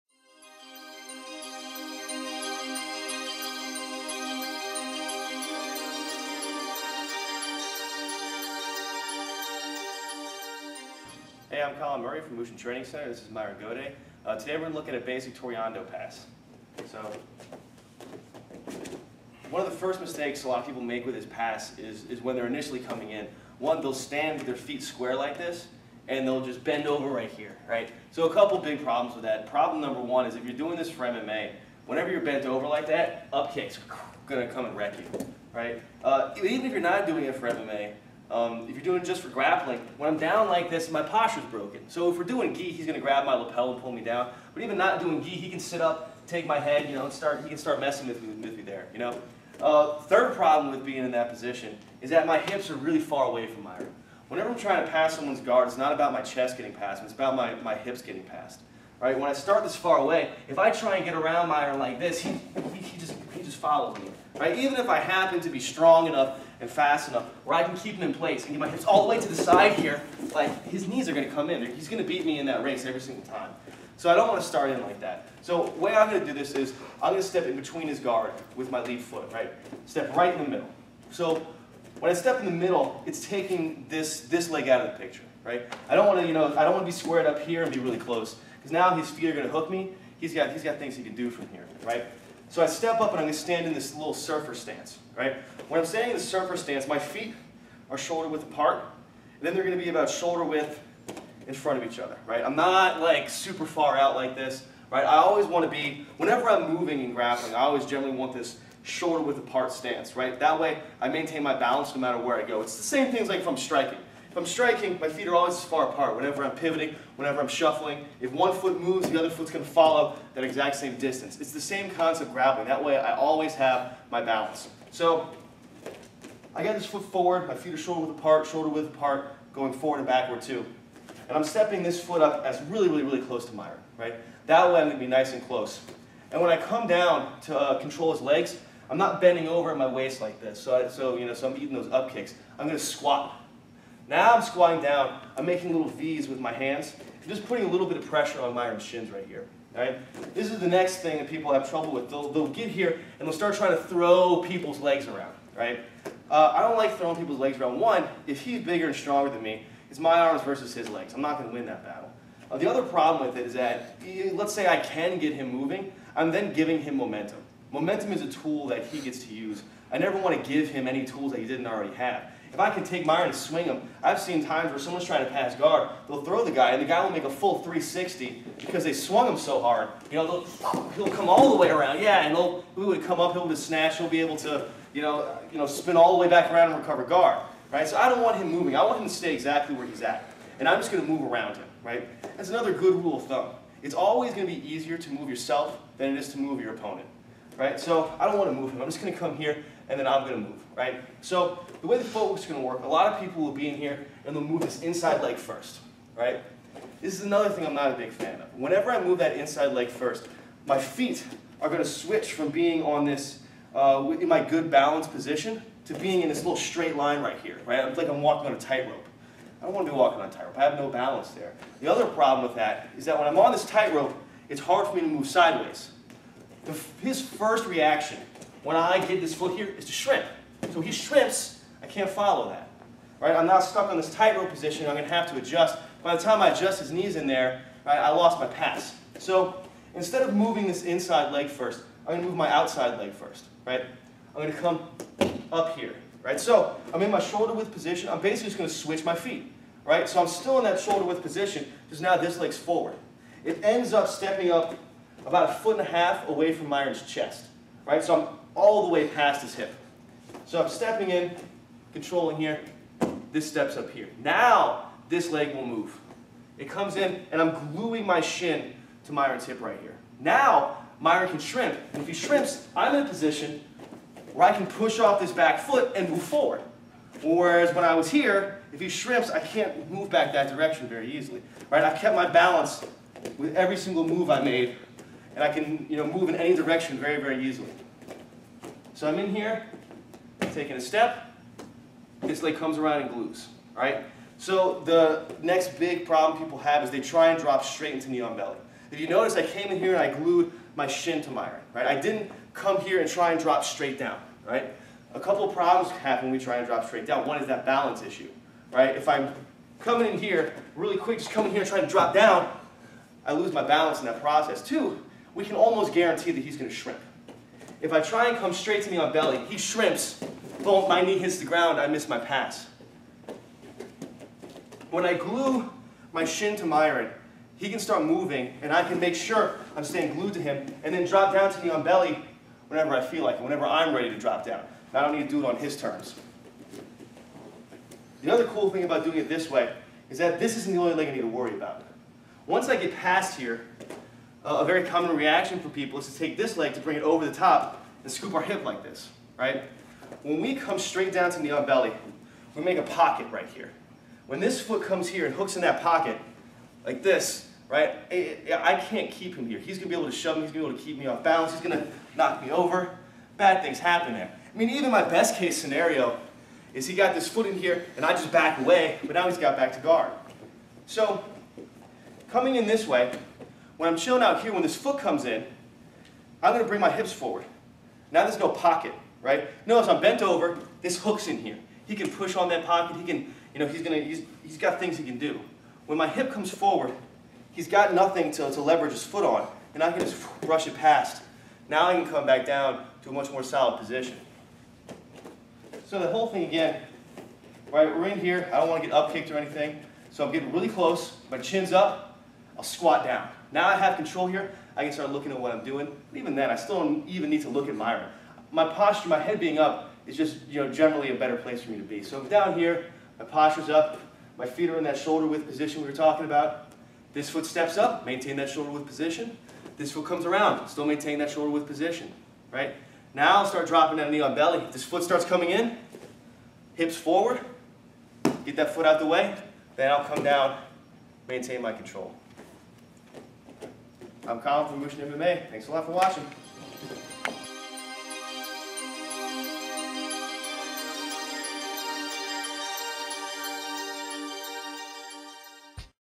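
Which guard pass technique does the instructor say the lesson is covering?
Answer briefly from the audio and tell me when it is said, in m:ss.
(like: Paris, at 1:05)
Toreando pass, at 0:15.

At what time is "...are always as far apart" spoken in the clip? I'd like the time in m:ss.
1:55.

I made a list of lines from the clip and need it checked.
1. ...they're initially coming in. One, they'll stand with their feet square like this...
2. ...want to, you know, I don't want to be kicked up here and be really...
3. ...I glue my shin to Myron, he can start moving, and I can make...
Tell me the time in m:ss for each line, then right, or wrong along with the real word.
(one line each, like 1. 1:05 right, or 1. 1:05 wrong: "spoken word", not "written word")
1. 0:22 right
2. 1:26 wrong: "squared", not "kicked"
3. 5:25 right.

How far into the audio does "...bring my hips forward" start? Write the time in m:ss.
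6:16.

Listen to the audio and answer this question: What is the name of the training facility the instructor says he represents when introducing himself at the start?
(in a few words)
Mushin Training Center.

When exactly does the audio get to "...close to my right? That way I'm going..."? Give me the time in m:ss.
2:13.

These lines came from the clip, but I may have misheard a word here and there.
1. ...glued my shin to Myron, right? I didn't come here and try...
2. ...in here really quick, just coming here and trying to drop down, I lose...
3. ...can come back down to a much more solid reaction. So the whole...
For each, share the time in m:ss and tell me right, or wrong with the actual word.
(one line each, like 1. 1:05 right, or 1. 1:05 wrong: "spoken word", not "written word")
1. 5:00 right
2. 5:10 right
3. 6:31 wrong: "position", not "reaction".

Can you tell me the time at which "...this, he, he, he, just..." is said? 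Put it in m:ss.
1:01.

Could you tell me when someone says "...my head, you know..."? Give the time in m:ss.
0:46.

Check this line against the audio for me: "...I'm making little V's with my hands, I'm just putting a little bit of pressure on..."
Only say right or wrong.
right.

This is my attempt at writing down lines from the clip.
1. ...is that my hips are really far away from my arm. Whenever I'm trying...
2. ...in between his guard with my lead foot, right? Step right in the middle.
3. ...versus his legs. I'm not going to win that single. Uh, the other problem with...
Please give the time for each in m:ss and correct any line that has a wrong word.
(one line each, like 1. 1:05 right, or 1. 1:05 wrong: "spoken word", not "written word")
1. 0:52 right
2. 1:17 right
3. 2:40 wrong: "battle", not "single".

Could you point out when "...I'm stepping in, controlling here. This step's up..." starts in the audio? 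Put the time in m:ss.
4:20.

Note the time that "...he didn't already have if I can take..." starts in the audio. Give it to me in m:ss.
2:51.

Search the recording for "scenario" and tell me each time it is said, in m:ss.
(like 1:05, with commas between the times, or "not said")
6:05.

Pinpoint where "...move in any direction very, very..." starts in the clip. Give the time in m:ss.
4:46.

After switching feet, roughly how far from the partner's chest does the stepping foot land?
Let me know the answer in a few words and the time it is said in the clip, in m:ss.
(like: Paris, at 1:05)
A foot and a half, at 4:15.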